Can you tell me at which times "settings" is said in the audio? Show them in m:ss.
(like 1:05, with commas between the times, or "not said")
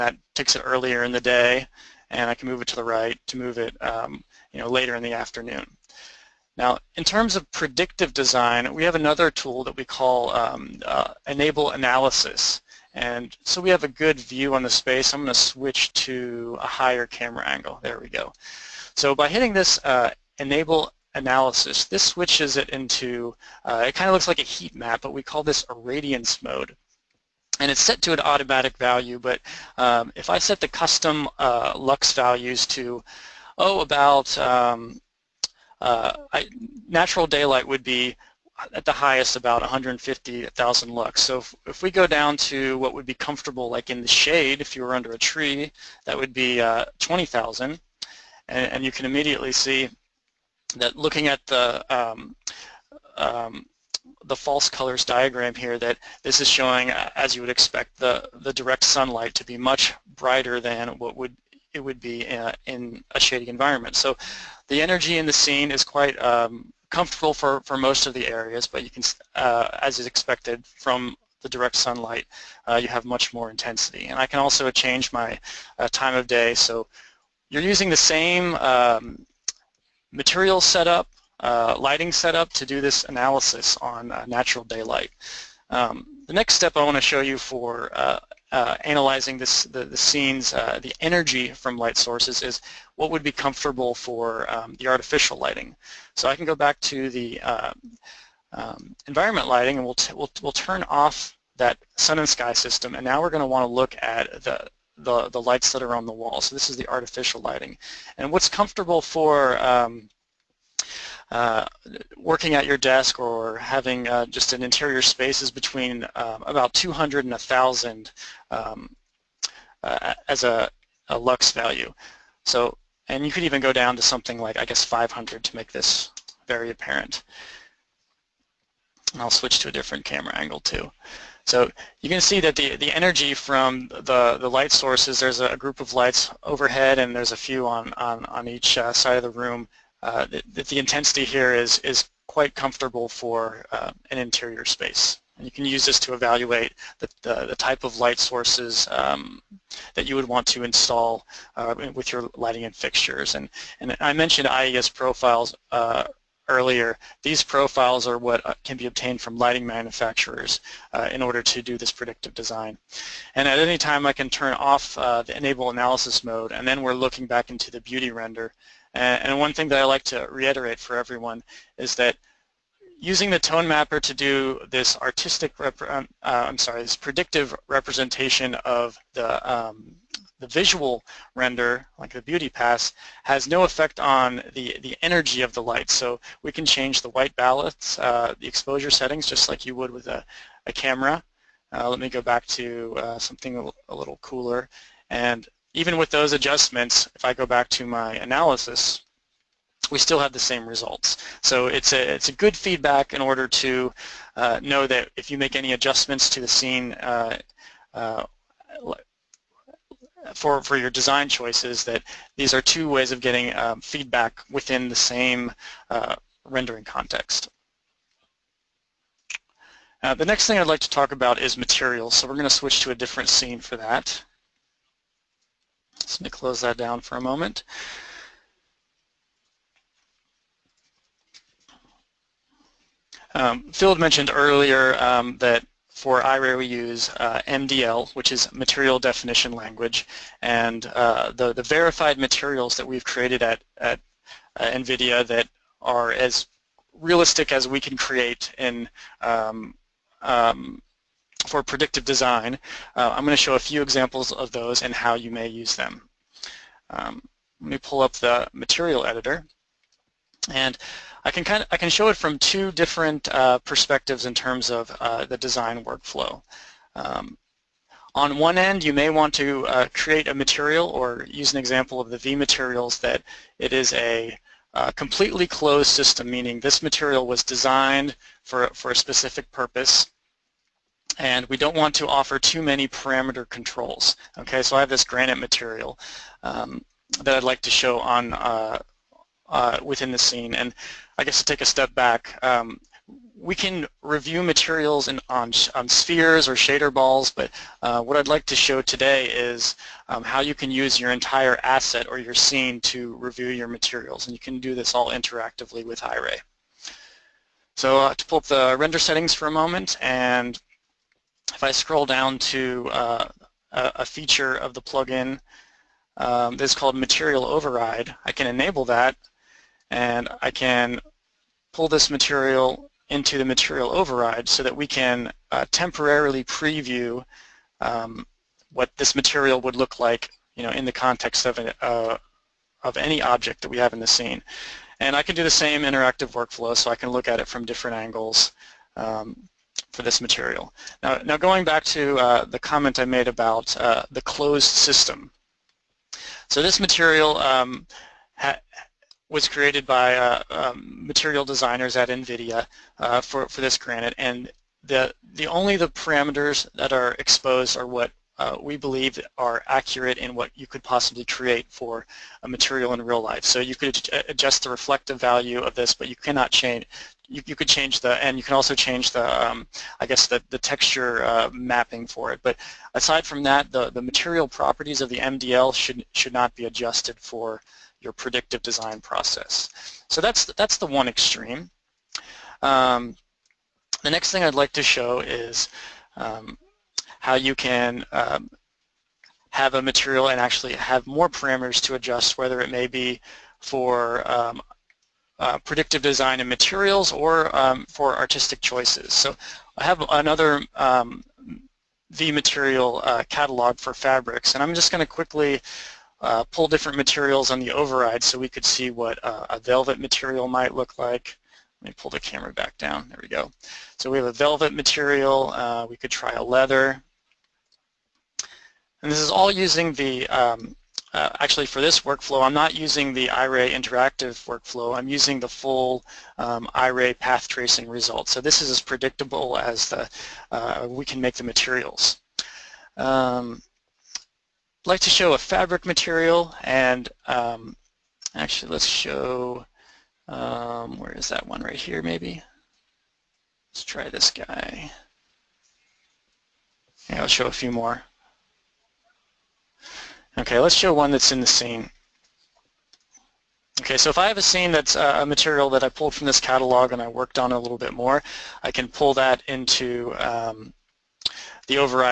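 3:08, 5:08.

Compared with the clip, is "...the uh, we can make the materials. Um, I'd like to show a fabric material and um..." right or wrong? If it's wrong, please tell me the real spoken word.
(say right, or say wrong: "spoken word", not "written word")
right.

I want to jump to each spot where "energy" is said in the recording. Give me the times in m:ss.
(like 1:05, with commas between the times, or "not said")
1:04, 1:30, 2:12, 3:05.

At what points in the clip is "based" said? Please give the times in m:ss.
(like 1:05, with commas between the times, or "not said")
not said.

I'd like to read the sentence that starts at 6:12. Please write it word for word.
But aside from that, the, the material properties of the MDL should, should not be adjusted for your predictive design process.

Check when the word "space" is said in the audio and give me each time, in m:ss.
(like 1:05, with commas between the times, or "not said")
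0:14, 1:54, 2:24.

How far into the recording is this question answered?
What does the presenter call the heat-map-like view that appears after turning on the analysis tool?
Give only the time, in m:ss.
0:25.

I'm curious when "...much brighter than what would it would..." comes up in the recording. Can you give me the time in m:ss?
0:59.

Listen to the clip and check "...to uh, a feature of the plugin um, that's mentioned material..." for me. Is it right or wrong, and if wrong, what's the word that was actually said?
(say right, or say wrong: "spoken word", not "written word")
wrong: "called", not "mentioned".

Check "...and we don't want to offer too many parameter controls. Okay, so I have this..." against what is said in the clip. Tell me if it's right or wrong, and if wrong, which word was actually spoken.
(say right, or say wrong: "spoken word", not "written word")
right.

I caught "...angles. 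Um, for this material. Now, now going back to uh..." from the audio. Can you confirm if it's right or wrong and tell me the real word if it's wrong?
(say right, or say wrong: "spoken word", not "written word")
right.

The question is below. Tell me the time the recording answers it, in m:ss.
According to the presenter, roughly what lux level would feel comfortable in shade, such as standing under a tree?
0:46.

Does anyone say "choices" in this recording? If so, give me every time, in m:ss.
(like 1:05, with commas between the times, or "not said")
3:31, 6:38.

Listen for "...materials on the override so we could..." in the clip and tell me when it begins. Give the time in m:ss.
6:46.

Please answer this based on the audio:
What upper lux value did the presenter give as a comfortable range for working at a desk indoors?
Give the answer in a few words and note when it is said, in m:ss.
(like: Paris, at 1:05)
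1,000, at 1:57.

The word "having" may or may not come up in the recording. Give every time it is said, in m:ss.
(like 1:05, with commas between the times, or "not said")
1:53.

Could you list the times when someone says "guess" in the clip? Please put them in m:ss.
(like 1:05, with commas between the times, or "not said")
2:04, 4:51, 6:10.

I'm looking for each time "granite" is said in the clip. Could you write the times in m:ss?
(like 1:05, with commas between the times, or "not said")
4:45, 5:53.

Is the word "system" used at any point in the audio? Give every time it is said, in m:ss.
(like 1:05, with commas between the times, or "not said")
1:42, 4:35, 5:44.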